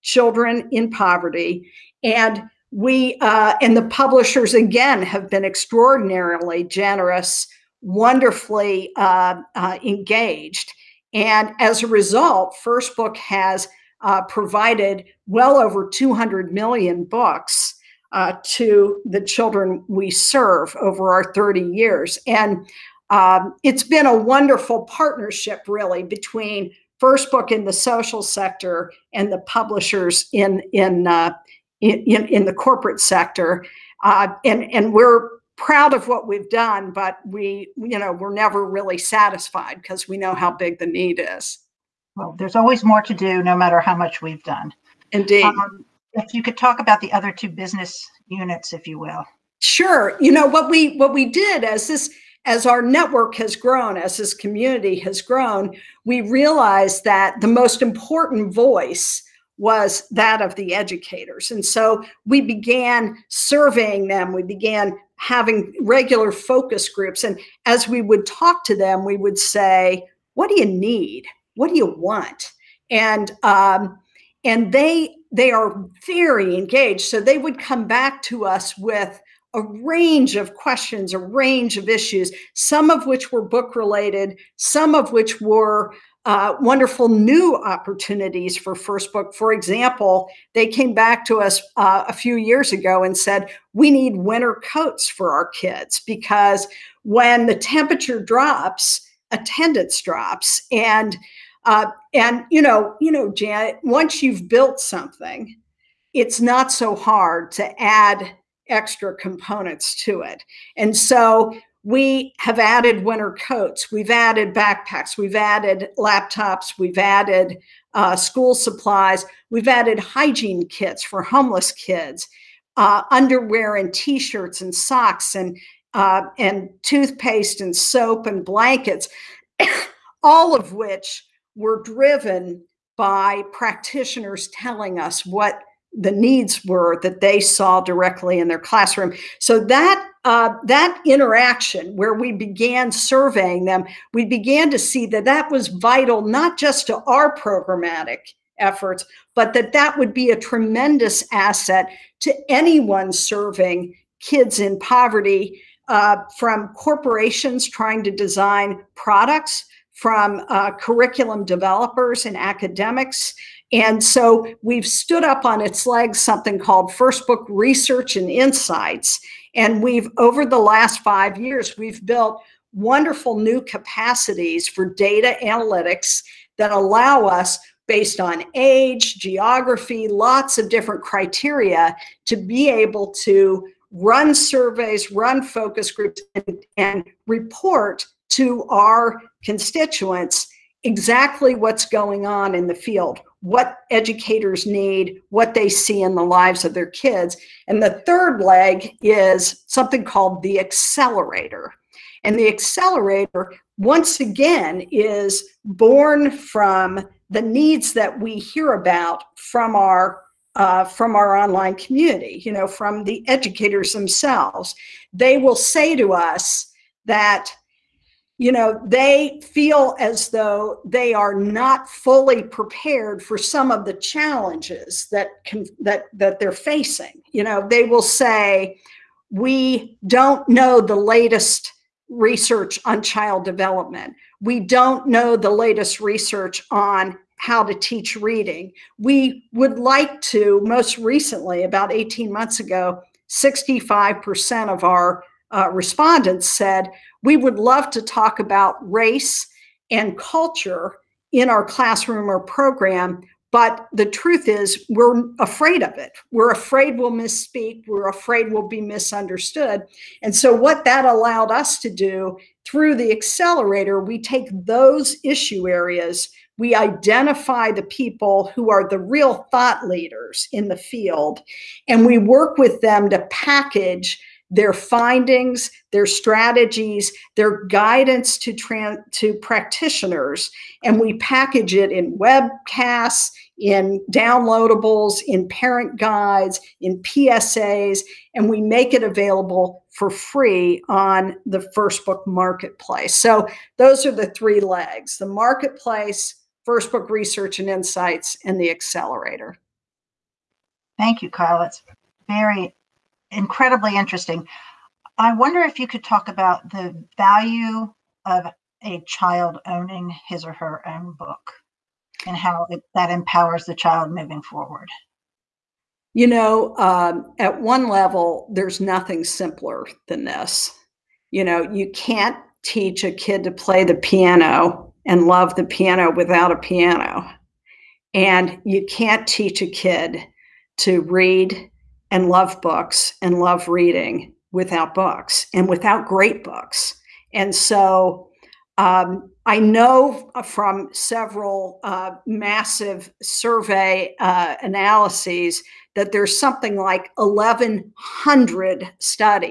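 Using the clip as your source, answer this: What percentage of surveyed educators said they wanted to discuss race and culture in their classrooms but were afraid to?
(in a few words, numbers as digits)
65%.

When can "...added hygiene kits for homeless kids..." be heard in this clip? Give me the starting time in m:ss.
1:59.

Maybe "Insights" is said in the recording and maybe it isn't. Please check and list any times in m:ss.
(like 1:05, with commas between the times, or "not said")
2:48, 4:57.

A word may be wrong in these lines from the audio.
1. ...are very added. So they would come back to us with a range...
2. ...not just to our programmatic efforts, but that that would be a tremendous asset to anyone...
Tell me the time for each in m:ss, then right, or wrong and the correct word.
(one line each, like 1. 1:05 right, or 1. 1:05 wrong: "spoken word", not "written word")
1. 1:15 wrong: "engaged", not "added"
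2. 2:26 right.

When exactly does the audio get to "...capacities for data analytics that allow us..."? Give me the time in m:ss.
2:53.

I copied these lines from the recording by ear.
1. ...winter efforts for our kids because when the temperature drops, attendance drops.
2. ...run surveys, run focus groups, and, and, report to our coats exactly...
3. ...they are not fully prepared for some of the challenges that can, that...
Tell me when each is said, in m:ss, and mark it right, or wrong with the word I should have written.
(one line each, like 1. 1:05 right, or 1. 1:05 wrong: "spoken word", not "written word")
1. 1:34 wrong: "coats", not "efforts"
2. 3:03 wrong: "constituents", not "coats"
3. 3:40 right.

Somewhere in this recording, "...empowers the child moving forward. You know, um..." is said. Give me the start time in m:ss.
5:13.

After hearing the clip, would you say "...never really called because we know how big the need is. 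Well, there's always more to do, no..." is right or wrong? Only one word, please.
wrong.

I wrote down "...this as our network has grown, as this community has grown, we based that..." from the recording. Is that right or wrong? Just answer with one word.
wrong.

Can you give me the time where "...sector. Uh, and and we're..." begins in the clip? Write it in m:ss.
0:32.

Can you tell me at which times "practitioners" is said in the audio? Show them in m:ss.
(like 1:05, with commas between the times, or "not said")
2:13, 4:39.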